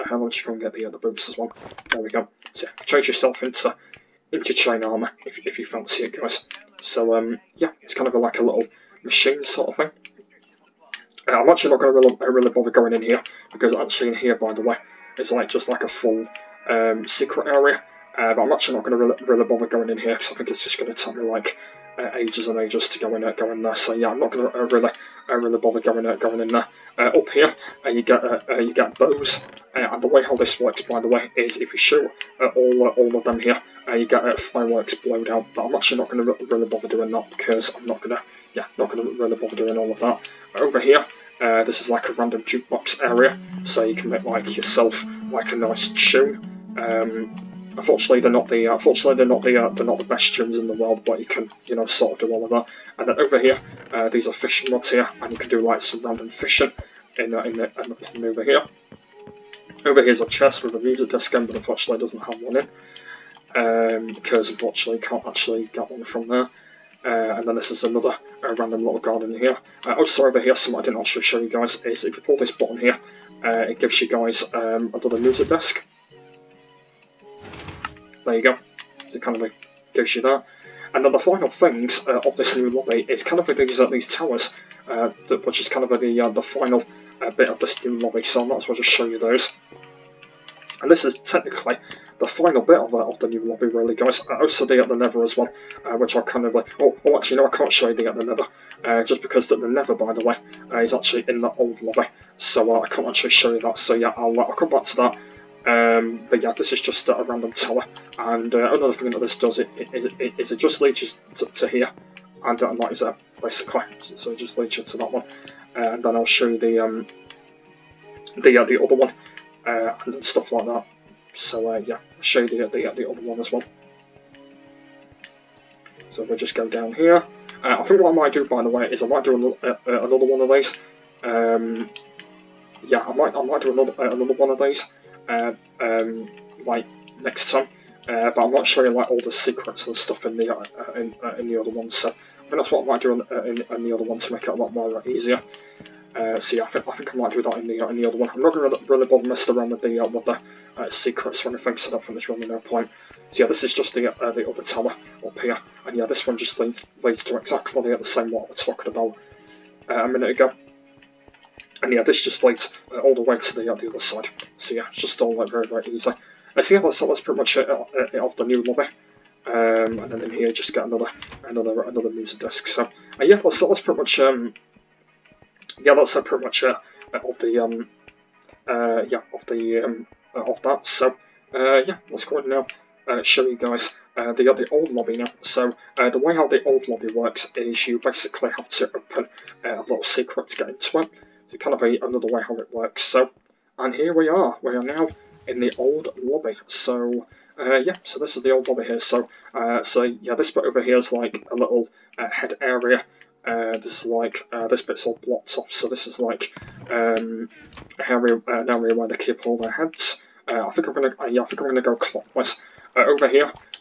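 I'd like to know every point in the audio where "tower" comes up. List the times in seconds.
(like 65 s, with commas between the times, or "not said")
84 s, 107 s, 154 s.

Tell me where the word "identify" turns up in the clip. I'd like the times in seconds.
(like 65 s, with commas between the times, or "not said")
not said.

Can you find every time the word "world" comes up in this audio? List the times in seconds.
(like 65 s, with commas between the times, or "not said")
50 s.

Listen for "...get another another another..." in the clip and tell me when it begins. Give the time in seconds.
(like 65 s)
170 s.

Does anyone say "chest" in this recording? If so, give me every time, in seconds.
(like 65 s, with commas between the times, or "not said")
60 s.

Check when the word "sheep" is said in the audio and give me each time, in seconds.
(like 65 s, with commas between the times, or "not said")
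not said.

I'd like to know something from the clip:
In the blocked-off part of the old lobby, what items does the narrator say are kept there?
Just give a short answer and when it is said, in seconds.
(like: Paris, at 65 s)
Heads, at 209 s.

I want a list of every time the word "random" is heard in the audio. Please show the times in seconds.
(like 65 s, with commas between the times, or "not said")
42 s, 56 s, 68 s, 107 s.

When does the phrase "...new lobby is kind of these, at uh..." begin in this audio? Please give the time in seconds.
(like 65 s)
82 s.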